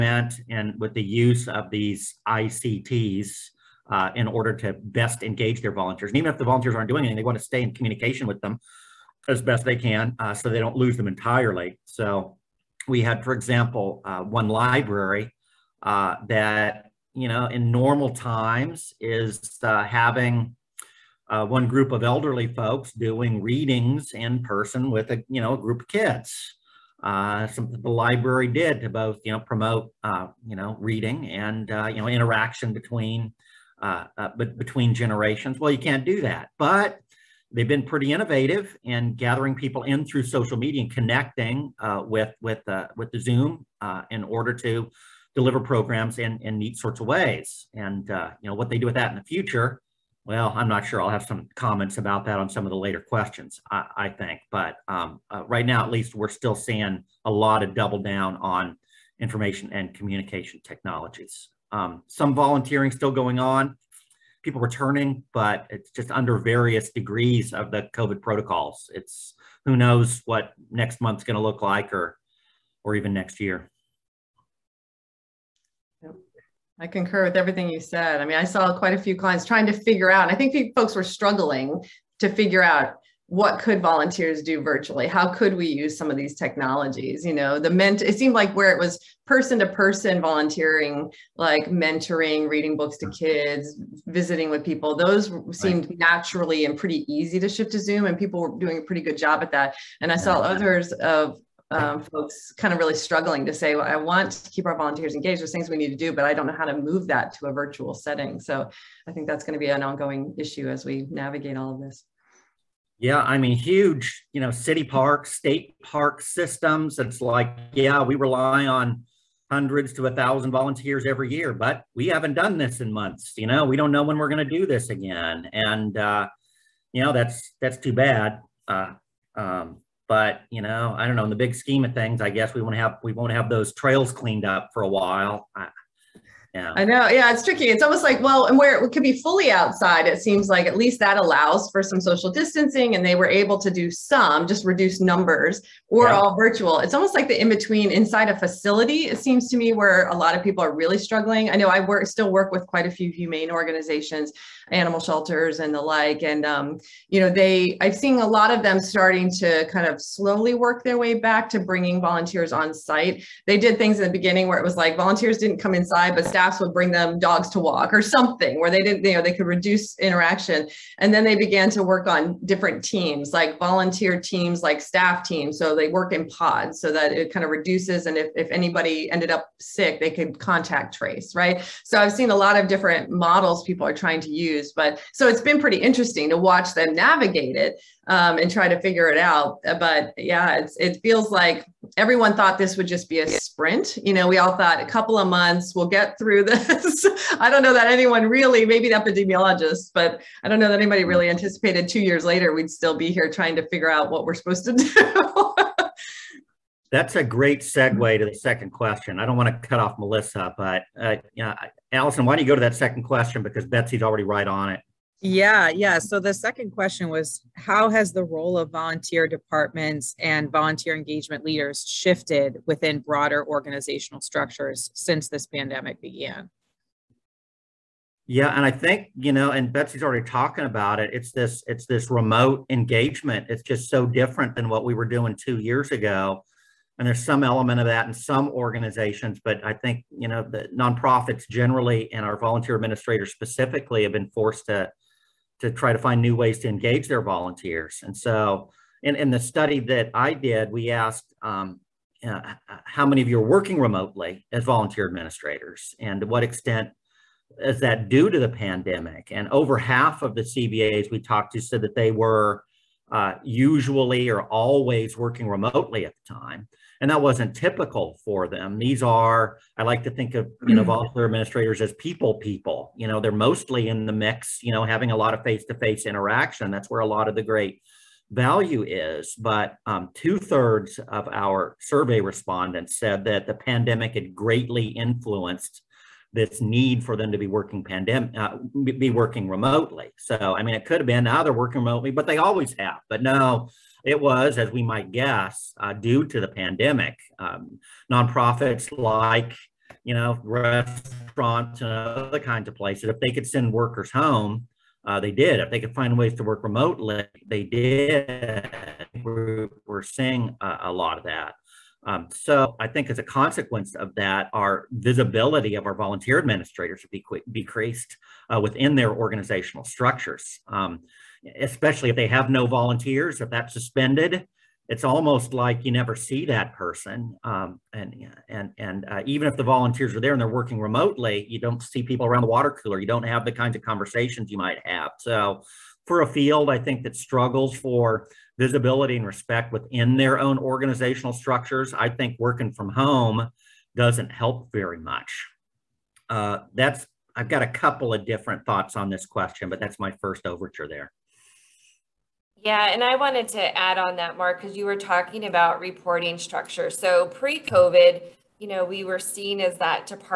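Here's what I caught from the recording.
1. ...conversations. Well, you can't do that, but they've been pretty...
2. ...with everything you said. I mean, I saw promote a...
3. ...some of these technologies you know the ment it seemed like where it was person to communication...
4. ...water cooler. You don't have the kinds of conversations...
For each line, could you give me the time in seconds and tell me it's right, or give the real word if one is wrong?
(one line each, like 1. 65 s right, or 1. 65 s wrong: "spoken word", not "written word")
1. 34 s wrong: "generations", not "conversations"
2. 77 s wrong: "quite", not "promote"
3. 85 s wrong: "person", not "communication"
4. 332 s right.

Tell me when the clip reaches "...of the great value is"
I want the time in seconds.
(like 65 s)
277 s.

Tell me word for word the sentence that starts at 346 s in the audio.
Uh, that's I've got a couple of different thoughts on this question, but that's my first overture there.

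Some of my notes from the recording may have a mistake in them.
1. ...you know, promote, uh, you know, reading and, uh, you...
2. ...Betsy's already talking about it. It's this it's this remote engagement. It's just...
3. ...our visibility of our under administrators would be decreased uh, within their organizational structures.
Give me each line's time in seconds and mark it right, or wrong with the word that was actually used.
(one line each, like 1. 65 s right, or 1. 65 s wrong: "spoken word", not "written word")
1. 29 s right
2. 229 s right
3. 314 s wrong: "volunteer", not "under".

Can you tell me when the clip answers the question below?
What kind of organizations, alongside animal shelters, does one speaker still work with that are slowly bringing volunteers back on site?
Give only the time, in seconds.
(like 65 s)
153 s.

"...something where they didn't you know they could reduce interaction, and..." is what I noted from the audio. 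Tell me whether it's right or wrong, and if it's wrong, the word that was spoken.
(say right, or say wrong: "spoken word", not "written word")
right.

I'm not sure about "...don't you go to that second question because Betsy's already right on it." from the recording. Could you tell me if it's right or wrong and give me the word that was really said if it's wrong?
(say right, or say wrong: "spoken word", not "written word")
right.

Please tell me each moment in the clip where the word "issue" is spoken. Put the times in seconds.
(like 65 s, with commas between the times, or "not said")
110 s.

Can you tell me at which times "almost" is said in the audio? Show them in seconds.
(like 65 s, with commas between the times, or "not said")
137 s, 146 s, 325 s.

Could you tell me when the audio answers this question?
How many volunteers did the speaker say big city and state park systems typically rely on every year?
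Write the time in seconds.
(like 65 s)
119 s.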